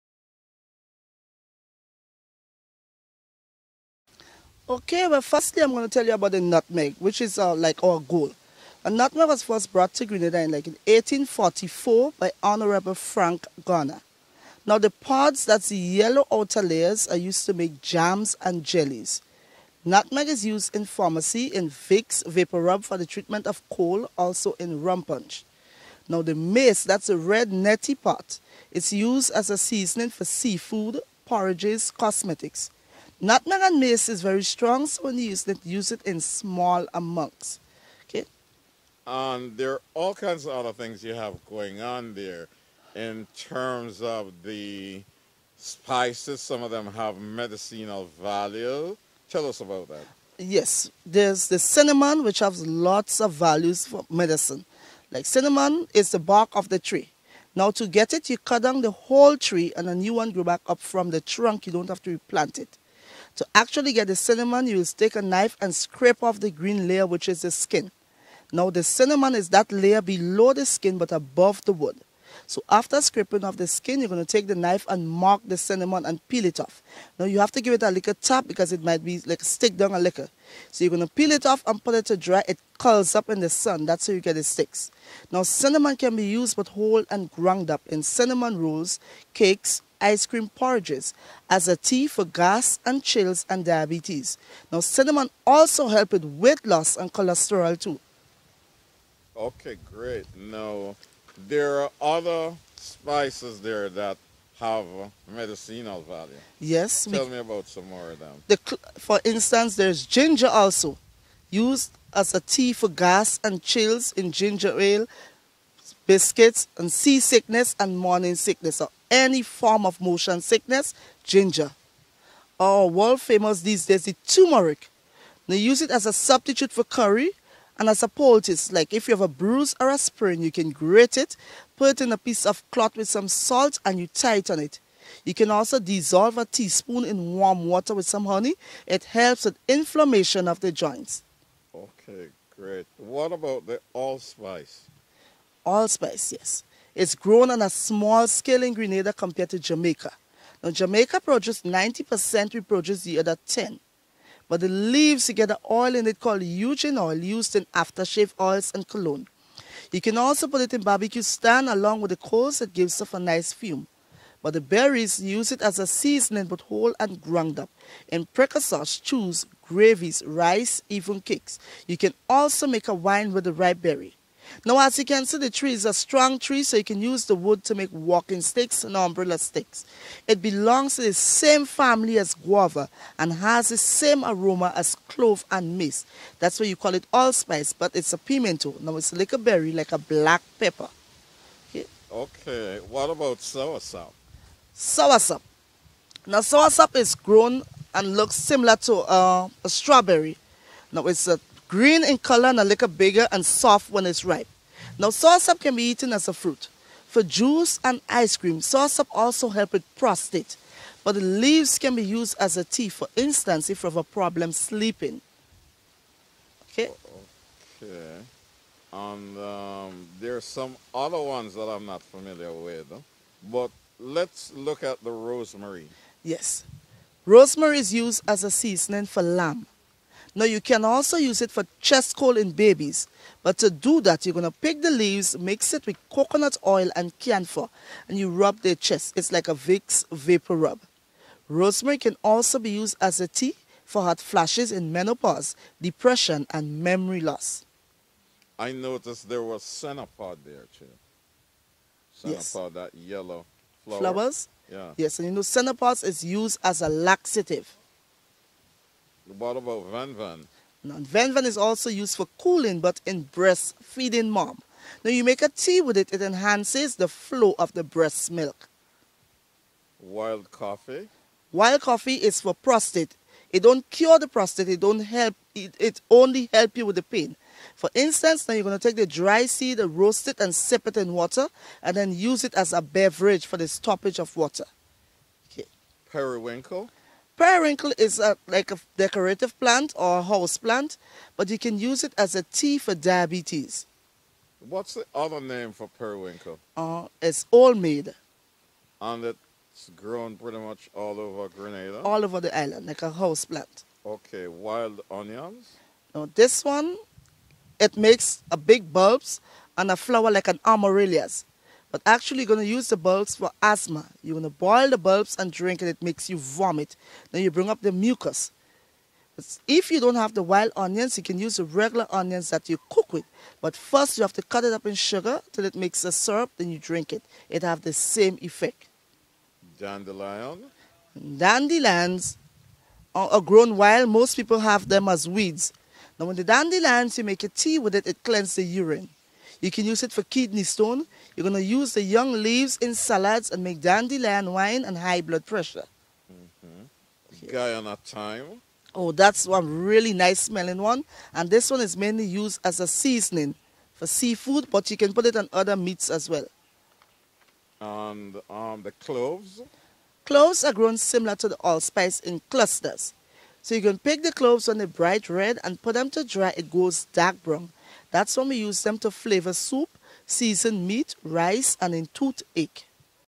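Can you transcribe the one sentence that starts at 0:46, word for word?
Some of them have medicinal value.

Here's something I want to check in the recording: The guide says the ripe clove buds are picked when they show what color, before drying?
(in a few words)
bright red.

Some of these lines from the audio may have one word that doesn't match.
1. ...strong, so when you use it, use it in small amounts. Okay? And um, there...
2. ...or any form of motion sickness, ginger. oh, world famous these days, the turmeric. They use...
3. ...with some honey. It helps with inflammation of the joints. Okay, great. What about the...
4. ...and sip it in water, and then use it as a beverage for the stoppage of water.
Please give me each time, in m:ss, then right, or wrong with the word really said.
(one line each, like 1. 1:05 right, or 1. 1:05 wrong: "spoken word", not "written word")
1. 0:34 right
2. 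1:58 right
3. 2:17 right
4. 4:40 right.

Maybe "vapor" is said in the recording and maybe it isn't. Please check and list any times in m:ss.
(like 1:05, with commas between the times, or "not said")
0:22, 4:00.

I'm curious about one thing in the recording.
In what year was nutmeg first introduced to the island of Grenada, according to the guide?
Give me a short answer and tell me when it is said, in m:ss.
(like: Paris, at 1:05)
1844, at 0:10.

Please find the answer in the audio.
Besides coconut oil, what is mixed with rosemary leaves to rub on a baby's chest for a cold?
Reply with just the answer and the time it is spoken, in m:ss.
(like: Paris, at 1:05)
camphor, at 3:57.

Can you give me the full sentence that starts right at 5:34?
Most people have them as weeds.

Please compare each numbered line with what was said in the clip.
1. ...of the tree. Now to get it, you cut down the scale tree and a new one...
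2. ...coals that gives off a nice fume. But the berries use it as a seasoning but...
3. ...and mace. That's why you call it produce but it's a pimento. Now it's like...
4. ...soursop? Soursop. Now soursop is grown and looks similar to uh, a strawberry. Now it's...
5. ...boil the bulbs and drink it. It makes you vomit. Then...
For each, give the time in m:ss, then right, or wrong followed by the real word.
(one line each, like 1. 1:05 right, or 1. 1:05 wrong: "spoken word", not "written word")
1. 0:56 wrong: "whole", not "scale"
2. 2:42 right
3. 3:05 wrong: "allspice", not "produce"
4. 3:13 right
5. 5:14 right.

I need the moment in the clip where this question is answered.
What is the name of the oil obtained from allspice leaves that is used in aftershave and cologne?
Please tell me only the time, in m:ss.
2:36.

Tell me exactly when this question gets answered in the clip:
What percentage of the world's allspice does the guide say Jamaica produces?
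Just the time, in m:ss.
2:31.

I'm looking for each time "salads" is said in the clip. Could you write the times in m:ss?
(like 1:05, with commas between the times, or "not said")
5:42.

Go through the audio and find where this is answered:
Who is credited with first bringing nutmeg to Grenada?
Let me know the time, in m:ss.
0:12.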